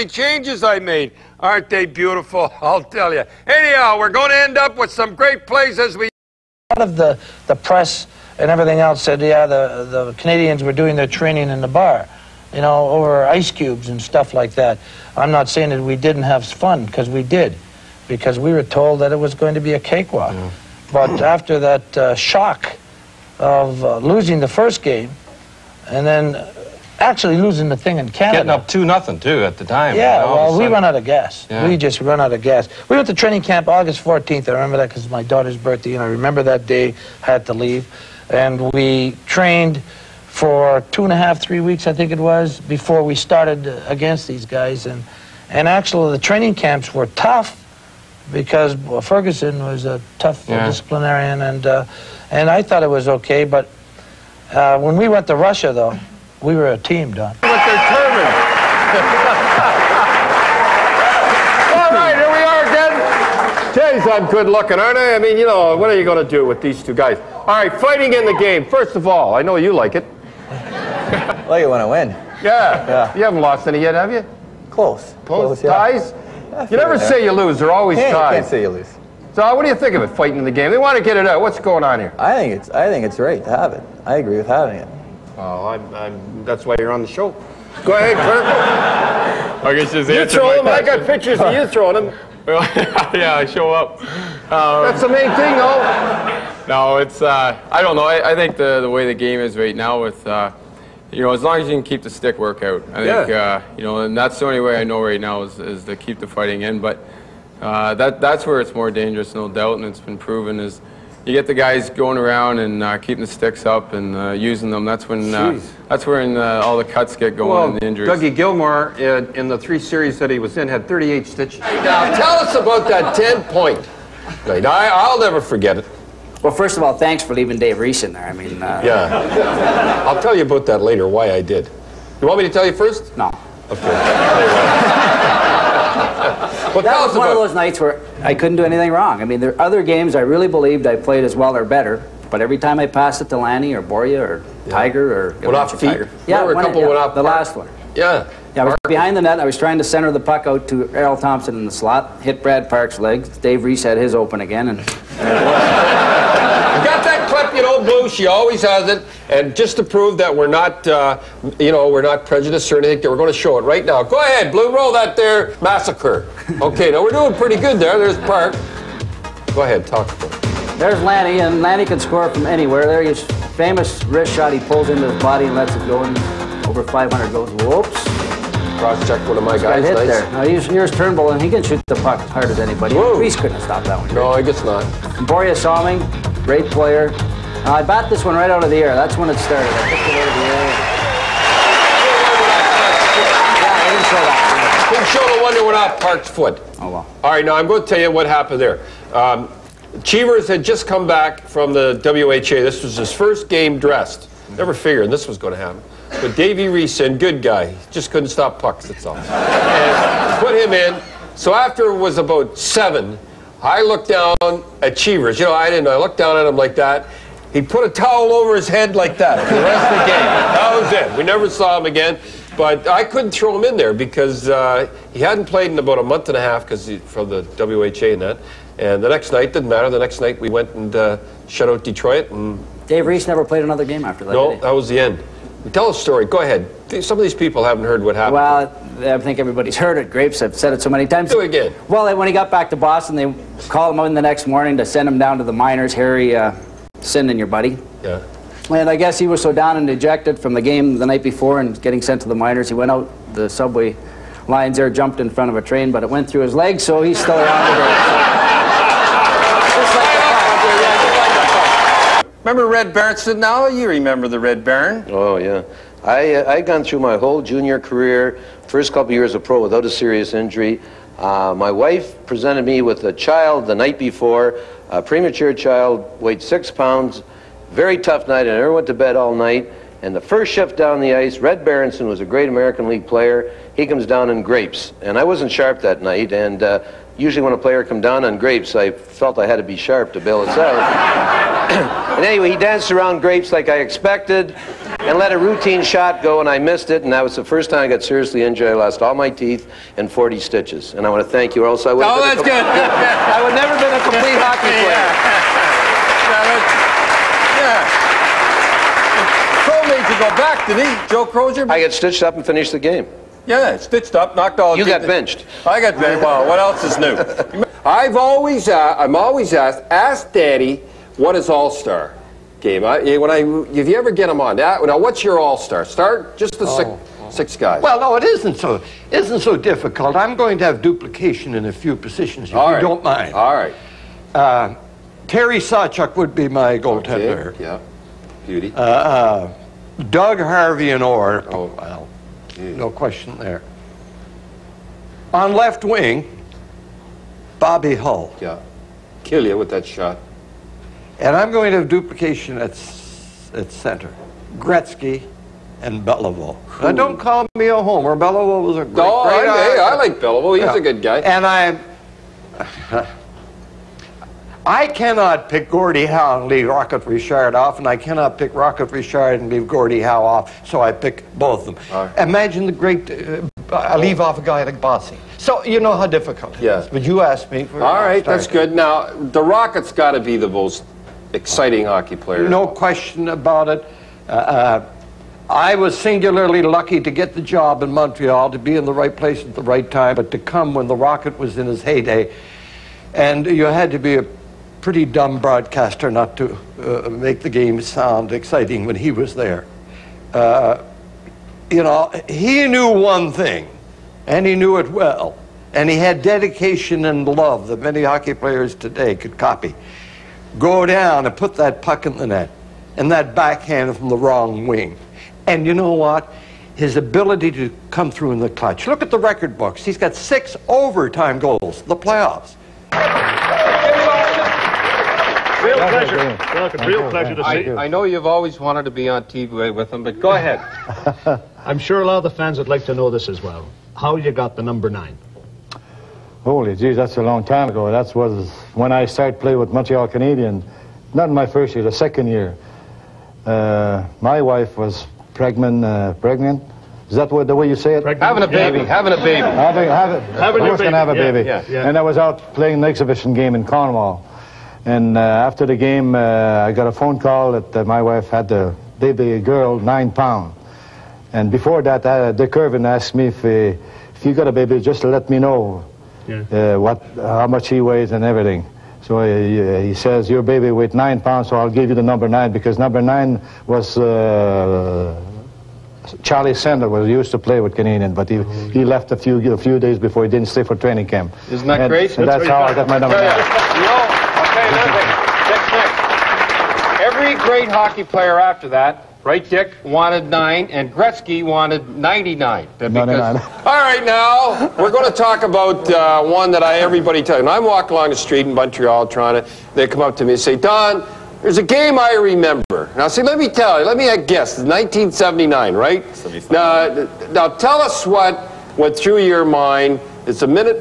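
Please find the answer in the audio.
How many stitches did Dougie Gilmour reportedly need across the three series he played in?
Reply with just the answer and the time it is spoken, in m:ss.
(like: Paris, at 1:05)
38, at 2:00.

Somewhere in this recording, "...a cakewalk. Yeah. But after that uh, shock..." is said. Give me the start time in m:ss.
0:19.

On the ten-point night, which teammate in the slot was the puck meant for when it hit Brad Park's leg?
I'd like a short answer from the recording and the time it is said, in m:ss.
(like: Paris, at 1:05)
Errol Thompson, at 2:30.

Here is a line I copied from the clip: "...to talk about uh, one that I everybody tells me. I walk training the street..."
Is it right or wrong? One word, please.
wrong.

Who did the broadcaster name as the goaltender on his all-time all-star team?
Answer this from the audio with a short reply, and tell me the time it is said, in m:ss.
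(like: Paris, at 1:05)
Terry Sawchuk, at 5:35.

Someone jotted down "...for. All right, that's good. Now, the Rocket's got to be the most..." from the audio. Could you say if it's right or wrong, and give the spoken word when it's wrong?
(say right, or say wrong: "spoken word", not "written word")
right.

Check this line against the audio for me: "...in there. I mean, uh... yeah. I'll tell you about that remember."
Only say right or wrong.
wrong.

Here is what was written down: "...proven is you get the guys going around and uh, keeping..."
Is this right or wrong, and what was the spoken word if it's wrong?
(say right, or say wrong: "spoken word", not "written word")
right.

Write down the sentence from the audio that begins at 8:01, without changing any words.
Isn't that and, And that's, that's how I got my number.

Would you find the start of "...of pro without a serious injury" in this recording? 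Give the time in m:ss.
4:29.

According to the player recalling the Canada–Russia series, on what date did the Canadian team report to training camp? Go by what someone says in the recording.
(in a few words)
August 14th.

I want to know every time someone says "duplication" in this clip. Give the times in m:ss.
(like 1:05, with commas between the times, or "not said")
5:30, 5:51.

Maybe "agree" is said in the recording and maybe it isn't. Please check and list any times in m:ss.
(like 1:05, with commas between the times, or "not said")
1:24.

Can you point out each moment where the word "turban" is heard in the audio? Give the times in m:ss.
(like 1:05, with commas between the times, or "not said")
0:57.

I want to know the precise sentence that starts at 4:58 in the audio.
I lost all my teeth and 40 stitches.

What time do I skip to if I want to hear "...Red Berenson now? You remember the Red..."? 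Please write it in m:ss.
4:22.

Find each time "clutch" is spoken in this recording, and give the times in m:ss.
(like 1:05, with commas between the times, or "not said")
6:58.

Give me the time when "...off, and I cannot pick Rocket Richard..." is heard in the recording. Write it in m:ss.
6:07.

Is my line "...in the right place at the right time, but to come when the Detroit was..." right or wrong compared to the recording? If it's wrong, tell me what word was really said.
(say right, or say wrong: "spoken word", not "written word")
wrong: "Rocket", not "Detroit".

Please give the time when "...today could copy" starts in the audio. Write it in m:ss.
6:48.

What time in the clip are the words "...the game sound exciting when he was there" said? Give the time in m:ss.
6:37.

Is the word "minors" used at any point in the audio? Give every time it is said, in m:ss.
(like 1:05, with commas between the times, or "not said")
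4:05, 4:12.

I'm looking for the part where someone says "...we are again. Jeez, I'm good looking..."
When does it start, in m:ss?
1:02.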